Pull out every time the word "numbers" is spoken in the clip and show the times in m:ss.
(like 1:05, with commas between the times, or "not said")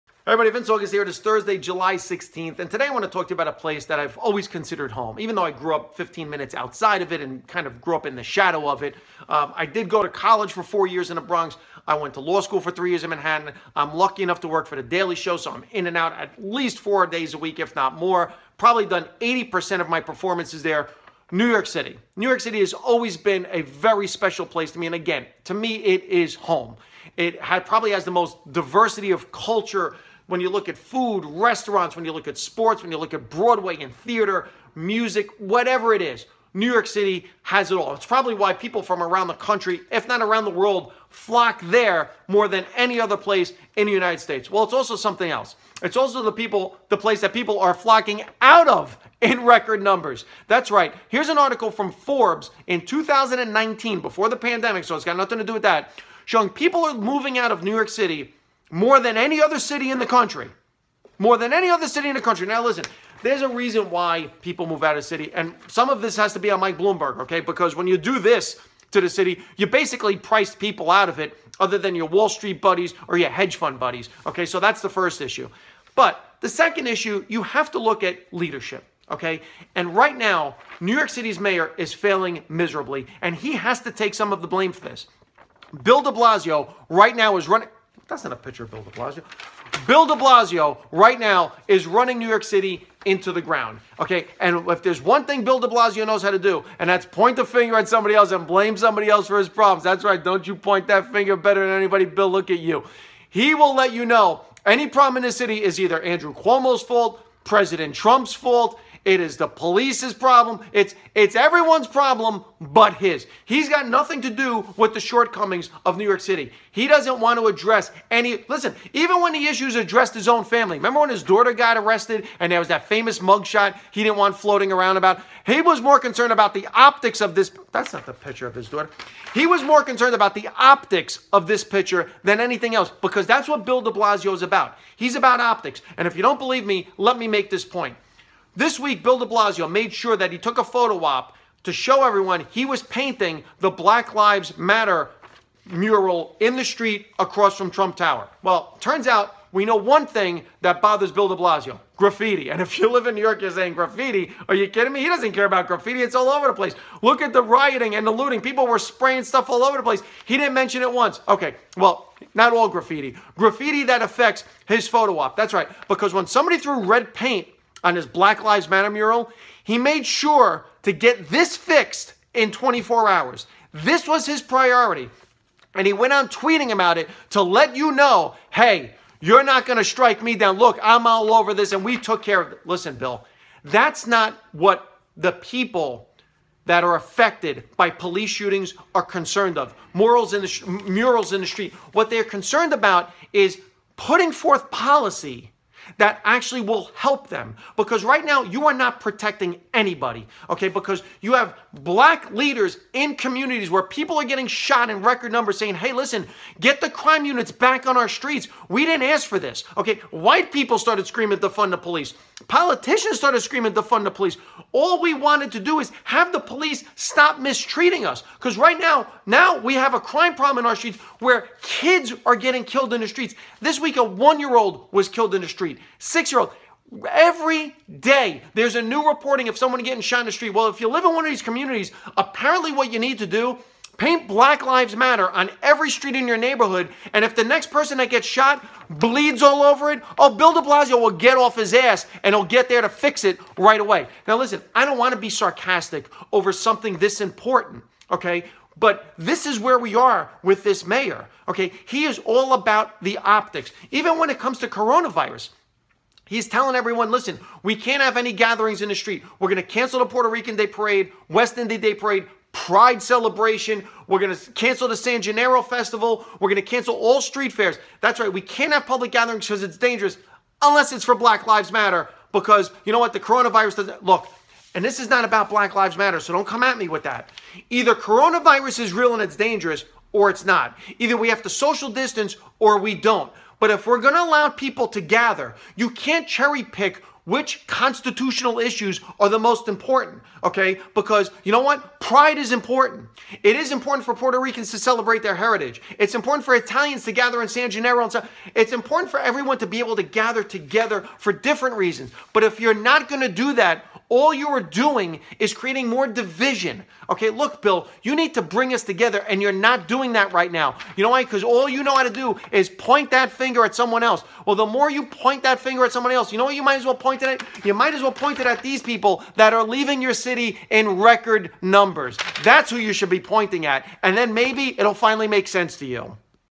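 0:49, 3:25, 5:21.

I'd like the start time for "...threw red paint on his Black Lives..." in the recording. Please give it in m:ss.
2:46.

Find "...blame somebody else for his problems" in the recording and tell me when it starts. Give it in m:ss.
1:38.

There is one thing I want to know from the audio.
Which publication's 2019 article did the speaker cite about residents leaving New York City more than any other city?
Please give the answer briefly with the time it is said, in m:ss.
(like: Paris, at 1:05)
Forbes, at 0:51.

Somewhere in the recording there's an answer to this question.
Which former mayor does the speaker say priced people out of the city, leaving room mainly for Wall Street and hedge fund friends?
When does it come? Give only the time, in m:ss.
1:06.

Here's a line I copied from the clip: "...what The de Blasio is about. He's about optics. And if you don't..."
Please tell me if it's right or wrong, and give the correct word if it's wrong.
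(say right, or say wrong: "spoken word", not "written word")
wrong: "Bill", not "The".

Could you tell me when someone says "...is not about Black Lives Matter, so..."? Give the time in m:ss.
4:35.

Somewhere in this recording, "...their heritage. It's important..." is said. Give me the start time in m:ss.
4:55.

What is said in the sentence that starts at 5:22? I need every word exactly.
That's who you should be pointing at, and then maybe it'll finally make sense to you.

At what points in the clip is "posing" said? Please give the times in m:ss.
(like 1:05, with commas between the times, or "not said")
not said.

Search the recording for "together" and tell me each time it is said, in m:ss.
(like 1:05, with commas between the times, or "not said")
5:00, 5:08.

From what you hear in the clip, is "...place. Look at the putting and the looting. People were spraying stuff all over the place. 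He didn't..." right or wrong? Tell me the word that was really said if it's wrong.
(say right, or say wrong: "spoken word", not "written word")
wrong: "rioting", not "putting".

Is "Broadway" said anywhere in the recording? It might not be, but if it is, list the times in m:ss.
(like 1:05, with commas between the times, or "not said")
0:33.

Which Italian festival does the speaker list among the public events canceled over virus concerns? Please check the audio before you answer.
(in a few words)
San Gennaro Festival.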